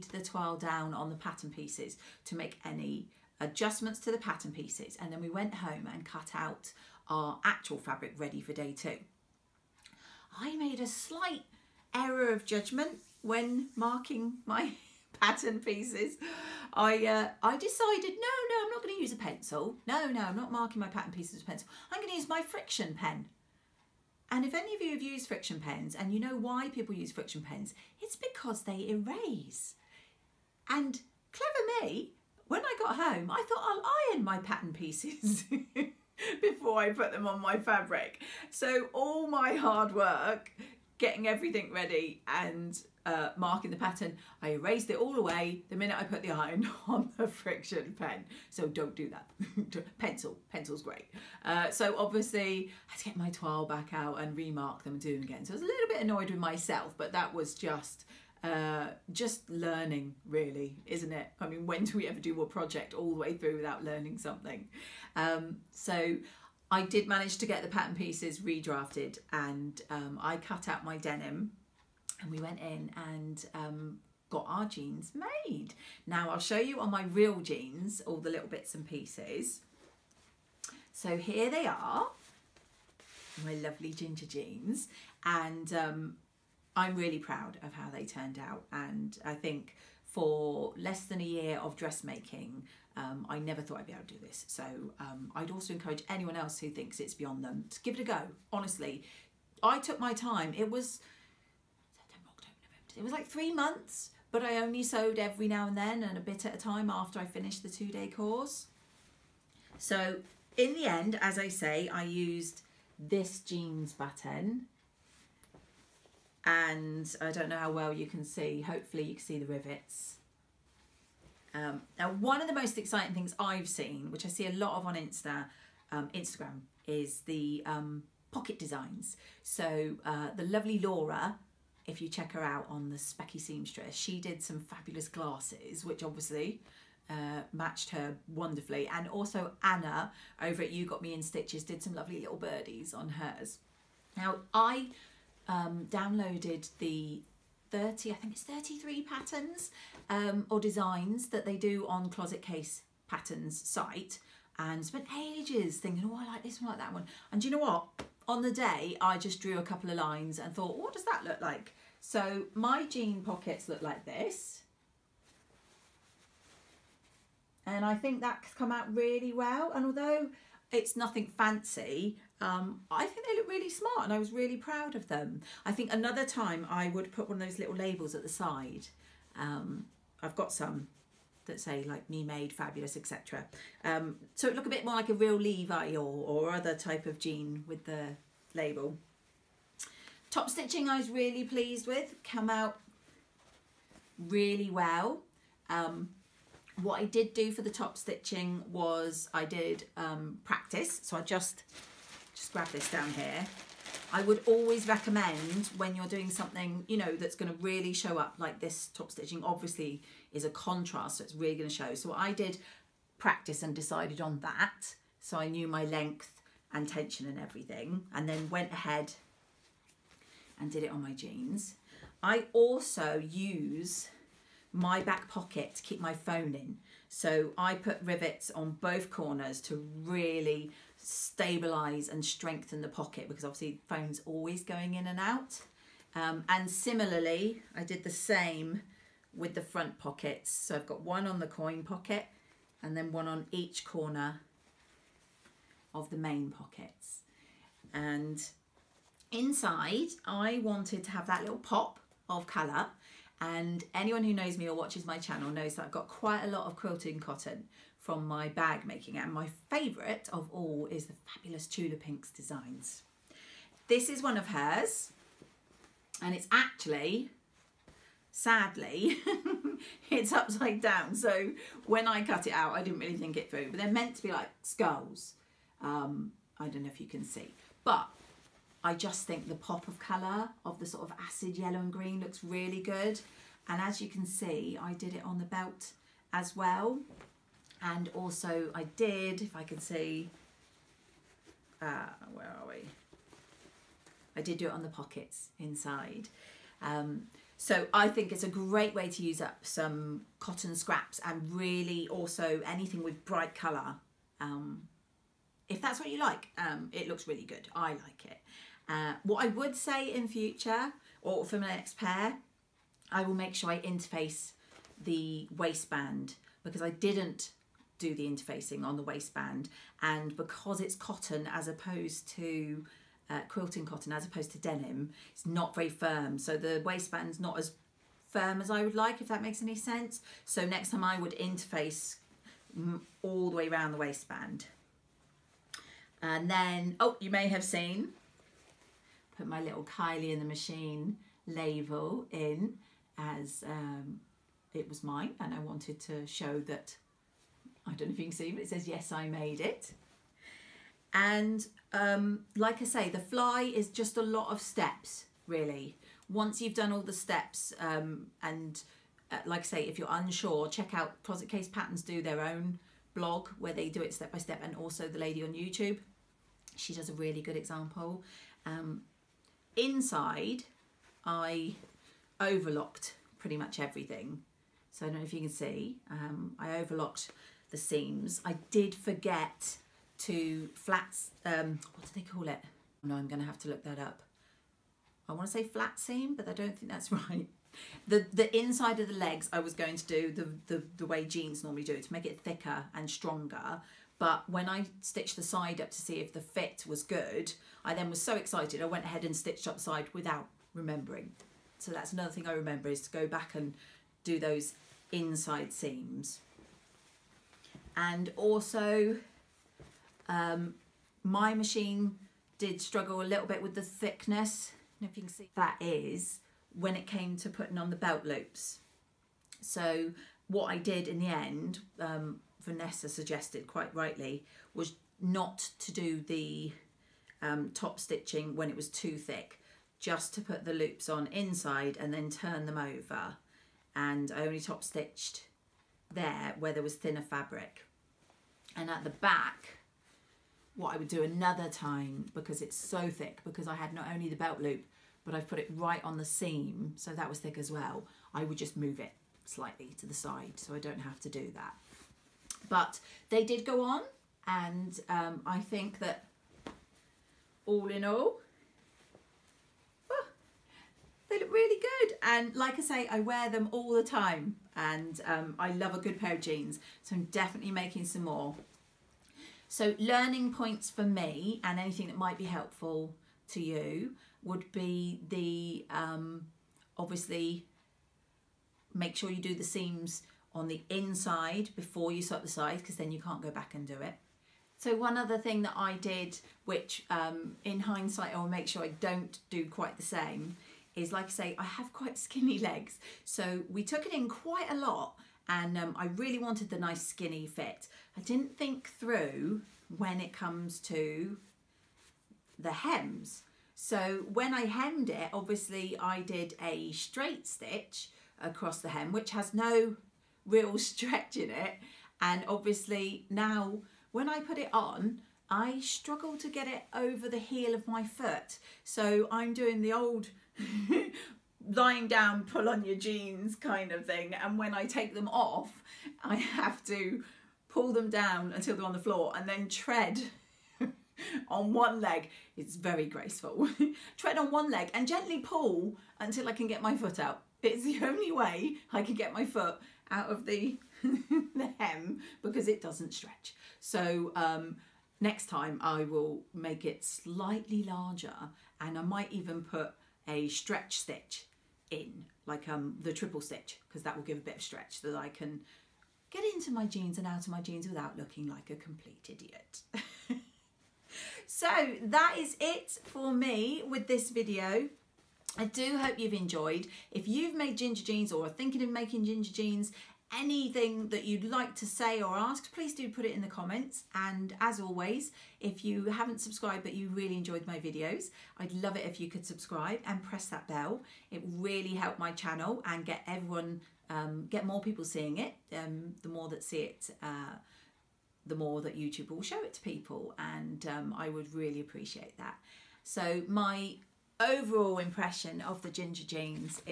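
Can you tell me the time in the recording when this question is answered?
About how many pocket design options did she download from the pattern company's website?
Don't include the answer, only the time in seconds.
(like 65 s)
148 s.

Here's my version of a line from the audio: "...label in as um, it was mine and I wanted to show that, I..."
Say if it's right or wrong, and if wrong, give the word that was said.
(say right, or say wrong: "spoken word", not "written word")
right.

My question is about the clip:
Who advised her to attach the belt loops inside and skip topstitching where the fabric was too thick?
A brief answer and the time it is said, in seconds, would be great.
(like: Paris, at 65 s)
Vanessa, at 422 s.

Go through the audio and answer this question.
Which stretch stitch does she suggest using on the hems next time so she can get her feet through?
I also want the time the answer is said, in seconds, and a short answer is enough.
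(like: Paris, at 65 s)
Triple stitch, at 553 s.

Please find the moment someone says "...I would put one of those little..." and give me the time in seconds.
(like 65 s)
176 s.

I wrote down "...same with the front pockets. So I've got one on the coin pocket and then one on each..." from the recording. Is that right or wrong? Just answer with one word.
right.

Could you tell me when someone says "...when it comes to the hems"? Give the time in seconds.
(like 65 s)
499 s.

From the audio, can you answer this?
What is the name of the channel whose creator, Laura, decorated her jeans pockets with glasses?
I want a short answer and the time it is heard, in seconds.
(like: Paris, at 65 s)
The Specky Seamstress, at 132 s.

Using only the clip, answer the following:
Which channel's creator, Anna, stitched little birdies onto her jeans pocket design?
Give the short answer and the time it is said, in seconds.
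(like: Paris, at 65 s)
You Got Me in Stitches, at 140 s.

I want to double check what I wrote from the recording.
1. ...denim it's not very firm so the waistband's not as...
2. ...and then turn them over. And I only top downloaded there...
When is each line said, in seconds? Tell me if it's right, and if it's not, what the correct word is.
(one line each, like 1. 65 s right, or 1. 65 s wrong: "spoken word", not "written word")
1. 324 s right
2. 431 s wrong: "stitched", not "downloaded".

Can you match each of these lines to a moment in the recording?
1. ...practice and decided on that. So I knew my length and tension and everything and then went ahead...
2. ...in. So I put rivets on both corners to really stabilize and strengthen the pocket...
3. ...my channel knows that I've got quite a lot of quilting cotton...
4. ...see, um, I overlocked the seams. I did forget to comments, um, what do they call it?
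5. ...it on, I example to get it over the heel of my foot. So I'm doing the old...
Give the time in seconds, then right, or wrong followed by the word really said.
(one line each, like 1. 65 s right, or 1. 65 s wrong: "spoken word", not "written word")
1. 213 s right
2. 226 s right
3. 255 s right
4. 375 s wrong: "flats", not "comments"
5. 514 s wrong: "struggle", not "example".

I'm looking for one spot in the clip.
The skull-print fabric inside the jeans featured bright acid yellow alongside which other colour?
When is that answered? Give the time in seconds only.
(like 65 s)
281 s.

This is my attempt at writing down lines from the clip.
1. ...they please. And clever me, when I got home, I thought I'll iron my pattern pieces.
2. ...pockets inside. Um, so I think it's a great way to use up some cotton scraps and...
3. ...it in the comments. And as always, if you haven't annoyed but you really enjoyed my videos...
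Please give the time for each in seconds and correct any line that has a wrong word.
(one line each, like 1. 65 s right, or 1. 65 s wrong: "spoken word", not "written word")
1. 28 s wrong: "erase", not "please"
2. 294 s right
3. 573 s wrong: "subscribed", not "annoyed".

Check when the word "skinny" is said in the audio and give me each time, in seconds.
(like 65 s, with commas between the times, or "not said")
492 s, 497 s.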